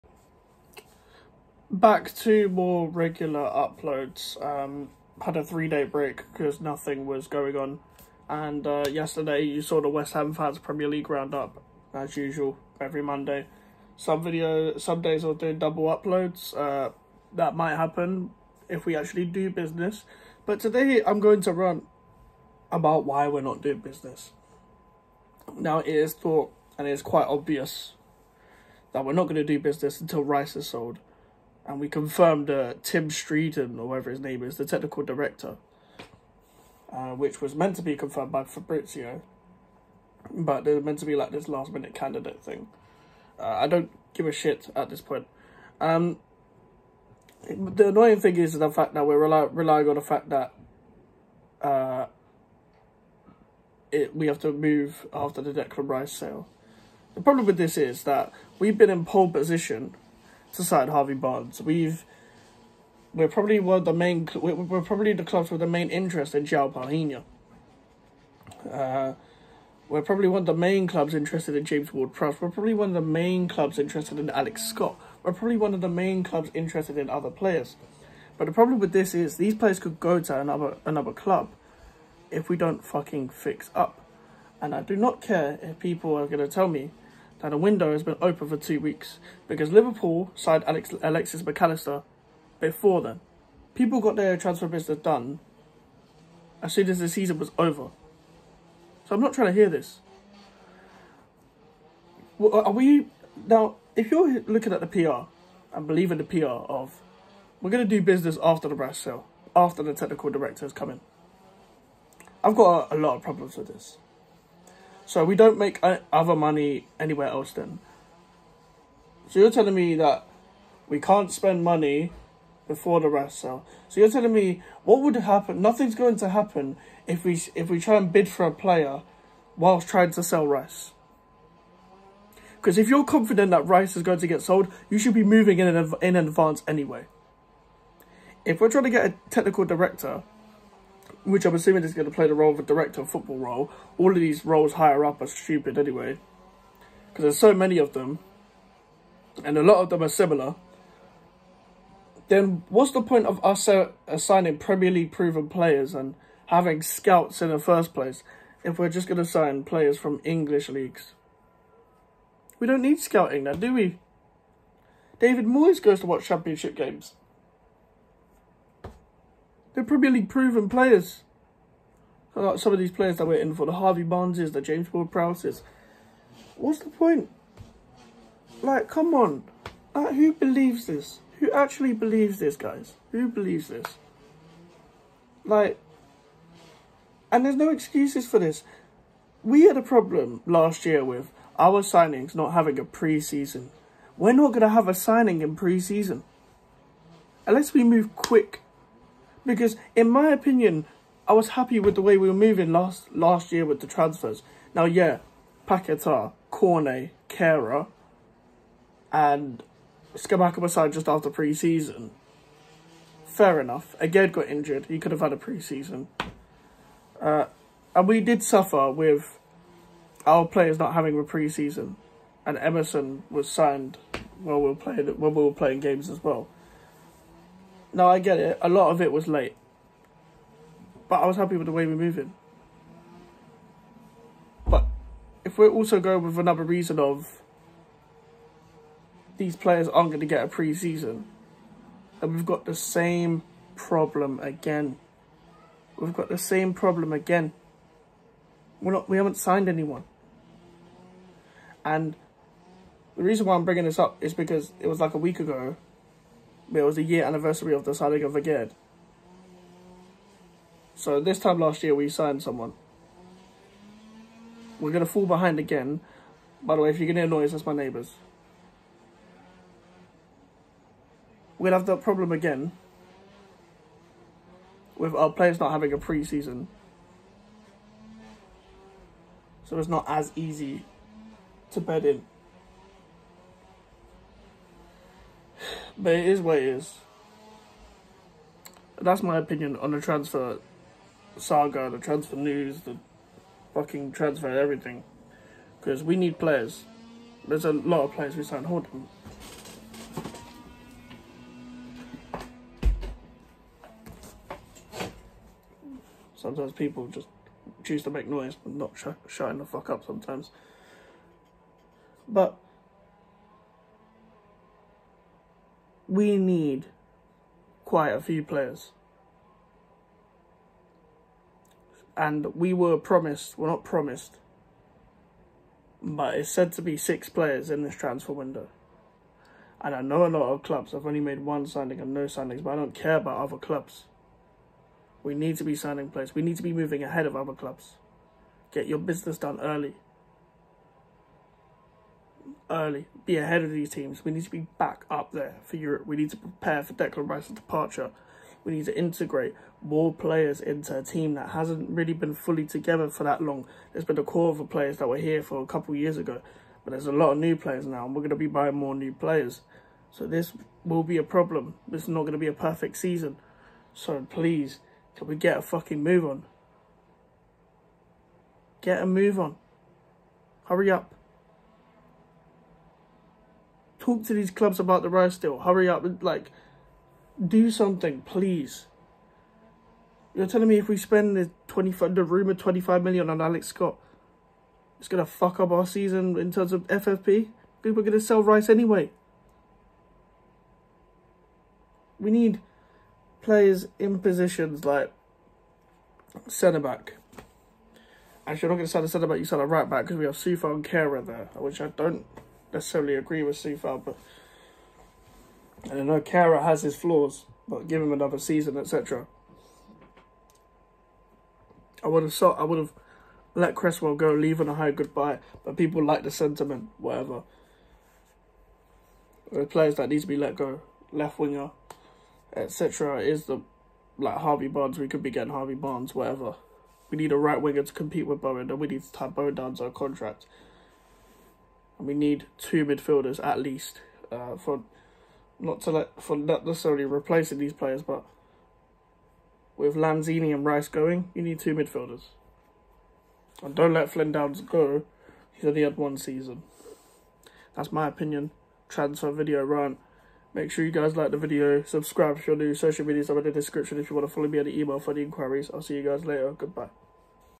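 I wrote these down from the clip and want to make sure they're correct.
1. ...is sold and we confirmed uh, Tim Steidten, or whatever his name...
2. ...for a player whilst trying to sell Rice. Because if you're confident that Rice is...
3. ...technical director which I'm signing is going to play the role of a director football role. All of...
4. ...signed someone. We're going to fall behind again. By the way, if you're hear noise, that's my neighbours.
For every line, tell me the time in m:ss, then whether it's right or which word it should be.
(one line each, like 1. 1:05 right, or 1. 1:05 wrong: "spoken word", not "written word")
1. 0:30 right
2. 2:08 right
3. 2:19 wrong: "assuming", not "signing"
4. 4:22 right.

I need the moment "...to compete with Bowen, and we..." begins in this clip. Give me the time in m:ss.
7:07.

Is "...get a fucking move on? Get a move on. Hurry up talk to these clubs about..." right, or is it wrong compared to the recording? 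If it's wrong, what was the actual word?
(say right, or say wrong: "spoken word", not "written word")
right.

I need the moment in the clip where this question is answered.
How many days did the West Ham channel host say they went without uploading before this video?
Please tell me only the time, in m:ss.
0:05.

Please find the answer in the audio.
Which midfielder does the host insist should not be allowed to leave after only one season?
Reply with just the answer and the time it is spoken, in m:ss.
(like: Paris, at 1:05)
Flynn Downes, at 7:24.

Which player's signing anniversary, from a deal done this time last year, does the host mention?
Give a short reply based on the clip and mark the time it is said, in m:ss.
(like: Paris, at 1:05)
Aguerd, at 4:18.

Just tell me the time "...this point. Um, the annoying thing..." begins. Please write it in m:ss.
0:44.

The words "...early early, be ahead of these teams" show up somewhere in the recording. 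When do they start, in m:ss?
5:39.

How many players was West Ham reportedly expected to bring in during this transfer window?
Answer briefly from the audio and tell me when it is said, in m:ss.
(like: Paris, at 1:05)
6, at 5:26.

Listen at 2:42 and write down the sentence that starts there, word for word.
We don't need scouting now, do we?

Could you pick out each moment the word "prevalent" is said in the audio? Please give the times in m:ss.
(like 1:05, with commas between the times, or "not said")
not said.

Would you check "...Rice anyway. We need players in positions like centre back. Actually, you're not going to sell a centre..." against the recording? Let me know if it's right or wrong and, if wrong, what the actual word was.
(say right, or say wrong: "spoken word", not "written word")
right.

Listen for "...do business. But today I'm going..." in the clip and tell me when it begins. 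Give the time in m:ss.
0:19.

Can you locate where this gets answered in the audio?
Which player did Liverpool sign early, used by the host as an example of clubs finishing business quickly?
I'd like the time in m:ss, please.
1:31.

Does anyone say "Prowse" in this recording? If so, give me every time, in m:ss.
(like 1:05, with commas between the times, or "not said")
1:11, 2:55.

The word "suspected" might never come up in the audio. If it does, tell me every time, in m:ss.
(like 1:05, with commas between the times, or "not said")
not said.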